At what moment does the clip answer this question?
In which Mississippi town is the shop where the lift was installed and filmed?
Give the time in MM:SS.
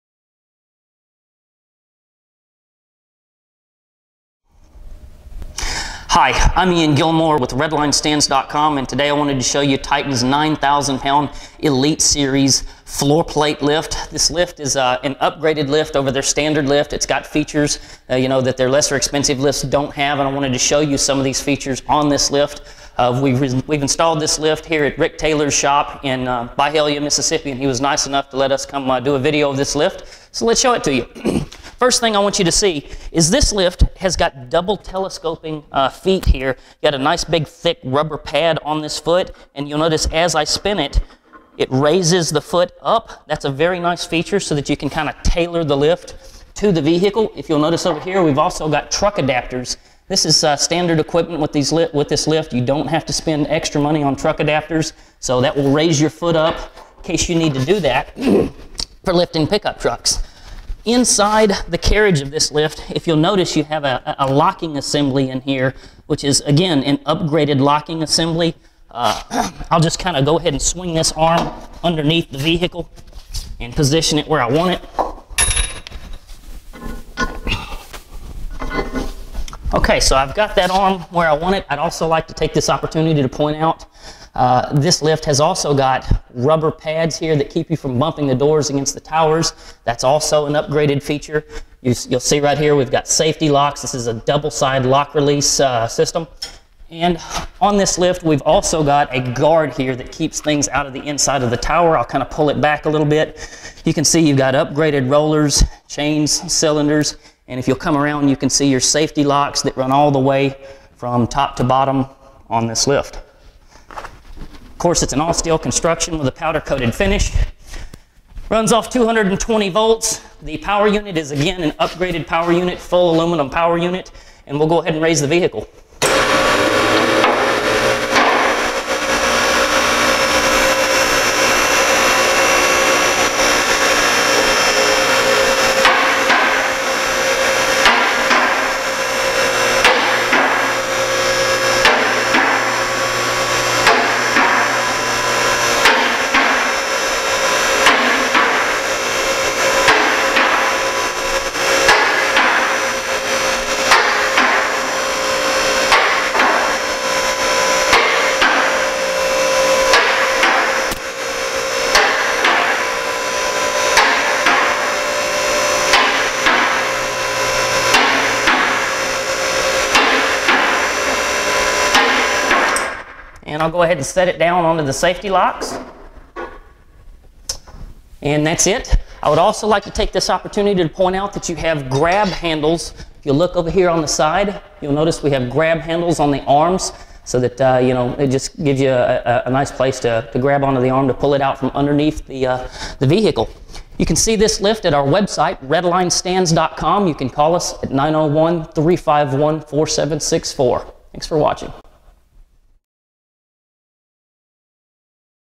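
00:26.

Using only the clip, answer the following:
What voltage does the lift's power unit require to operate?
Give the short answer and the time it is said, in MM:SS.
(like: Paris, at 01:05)
220 volts, at 01:58.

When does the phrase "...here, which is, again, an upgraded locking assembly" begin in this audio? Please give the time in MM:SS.
01:05.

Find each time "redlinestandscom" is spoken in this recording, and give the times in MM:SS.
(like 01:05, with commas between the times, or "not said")
00:07, 03:15.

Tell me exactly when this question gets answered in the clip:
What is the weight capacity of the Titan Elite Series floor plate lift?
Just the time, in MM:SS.
00:10.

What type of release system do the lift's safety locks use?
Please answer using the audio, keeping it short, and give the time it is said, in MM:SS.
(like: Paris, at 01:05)
Double-side lock release, at 01:34.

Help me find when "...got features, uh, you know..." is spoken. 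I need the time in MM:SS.
00:17.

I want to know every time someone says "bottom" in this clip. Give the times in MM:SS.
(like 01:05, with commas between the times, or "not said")
01:51.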